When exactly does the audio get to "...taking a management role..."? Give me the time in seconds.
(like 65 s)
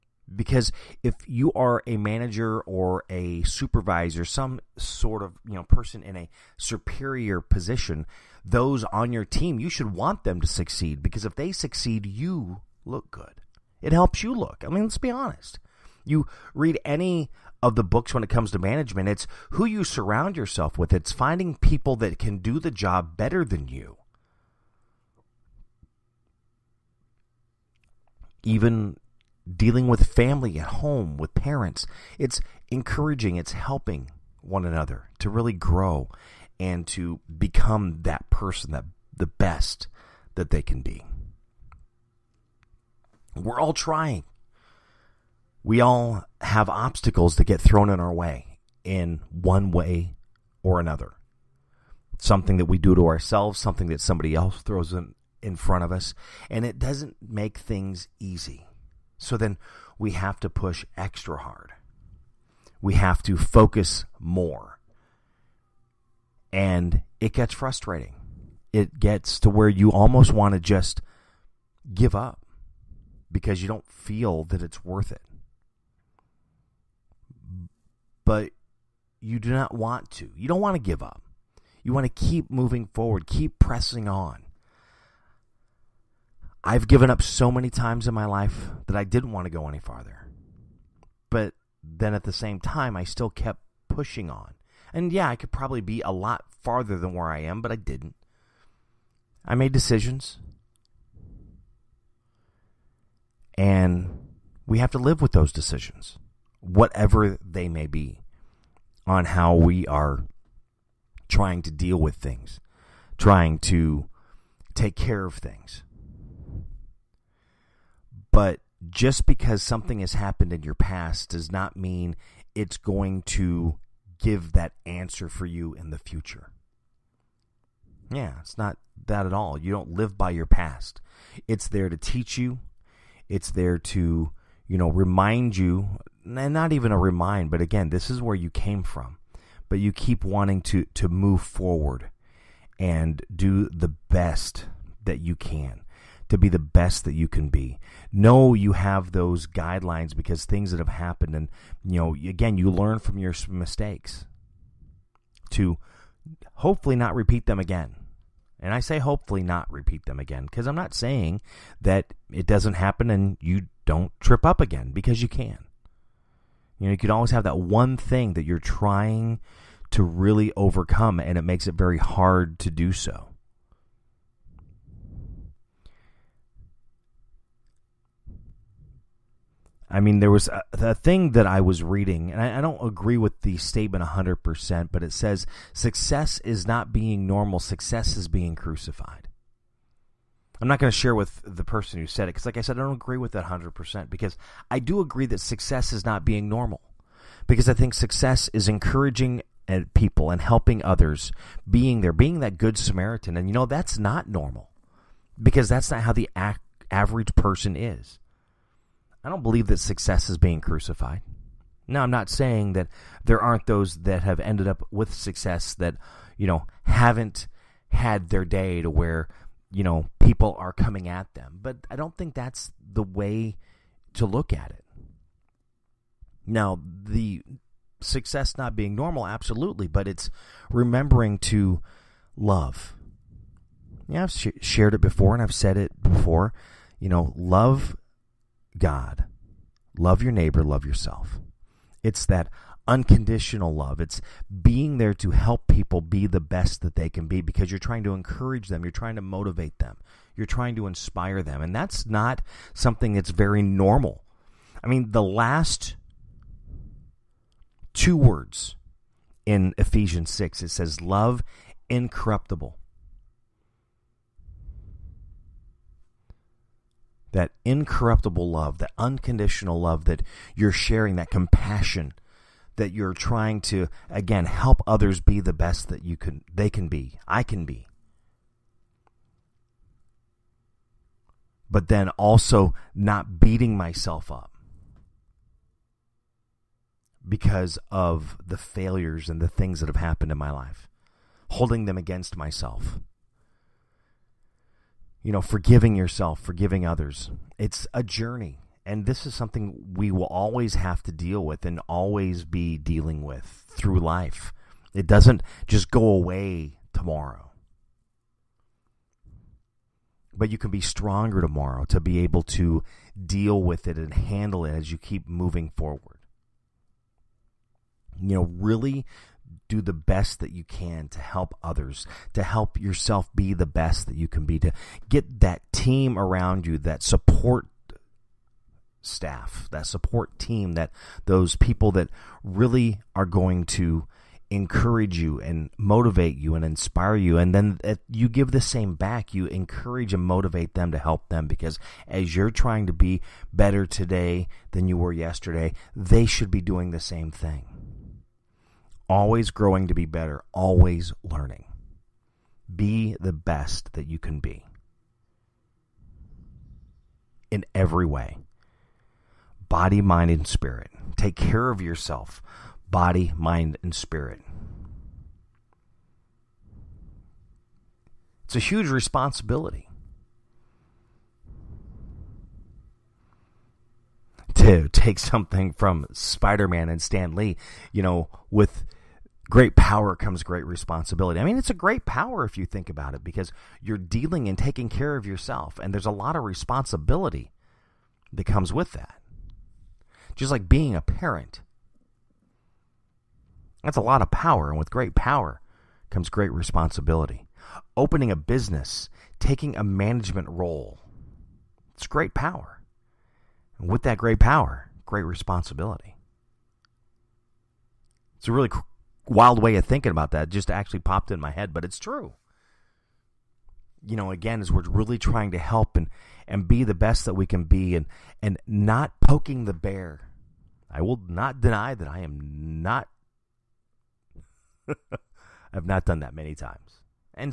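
399 s.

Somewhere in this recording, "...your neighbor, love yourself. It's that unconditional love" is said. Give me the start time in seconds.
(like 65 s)
240 s.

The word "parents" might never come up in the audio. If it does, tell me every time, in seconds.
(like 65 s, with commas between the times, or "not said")
31 s, 391 s.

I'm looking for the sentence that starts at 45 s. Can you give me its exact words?
We all have obstacles that get thrown in our way in one way or another.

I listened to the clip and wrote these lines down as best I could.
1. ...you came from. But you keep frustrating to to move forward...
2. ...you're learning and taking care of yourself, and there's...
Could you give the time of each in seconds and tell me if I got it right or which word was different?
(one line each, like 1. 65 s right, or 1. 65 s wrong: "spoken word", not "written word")
1. 138 s wrong: "wanting", not "frustrating"
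2. 383 s wrong: "dealing", not "learning".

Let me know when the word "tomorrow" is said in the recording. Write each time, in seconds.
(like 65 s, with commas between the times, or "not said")
306 s, 311 s.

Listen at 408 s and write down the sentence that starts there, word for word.
It's a really wild way of thinking about that just actually popped in my head, but it's true.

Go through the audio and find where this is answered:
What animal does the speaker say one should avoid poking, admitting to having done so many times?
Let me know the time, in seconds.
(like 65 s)
419 s.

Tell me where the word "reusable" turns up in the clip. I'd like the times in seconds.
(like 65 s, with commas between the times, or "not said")
not said.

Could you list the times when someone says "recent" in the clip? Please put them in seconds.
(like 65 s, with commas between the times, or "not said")
not said.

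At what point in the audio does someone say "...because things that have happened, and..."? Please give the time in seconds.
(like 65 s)
150 s.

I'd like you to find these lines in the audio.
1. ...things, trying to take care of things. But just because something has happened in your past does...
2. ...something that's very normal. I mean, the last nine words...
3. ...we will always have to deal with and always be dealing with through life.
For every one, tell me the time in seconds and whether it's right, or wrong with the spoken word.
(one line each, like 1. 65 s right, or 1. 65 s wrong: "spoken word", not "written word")
1. 112 s right
2. 252 s wrong: "two", not "nine"
3. 299 s right.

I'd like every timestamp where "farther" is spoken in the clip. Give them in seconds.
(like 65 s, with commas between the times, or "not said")
89 s, 96 s.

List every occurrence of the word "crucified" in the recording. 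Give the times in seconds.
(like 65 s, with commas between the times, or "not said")
188 s, 210 s.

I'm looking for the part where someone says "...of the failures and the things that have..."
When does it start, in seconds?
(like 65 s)
287 s.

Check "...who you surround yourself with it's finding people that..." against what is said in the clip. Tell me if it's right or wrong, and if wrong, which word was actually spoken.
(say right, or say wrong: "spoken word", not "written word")
right.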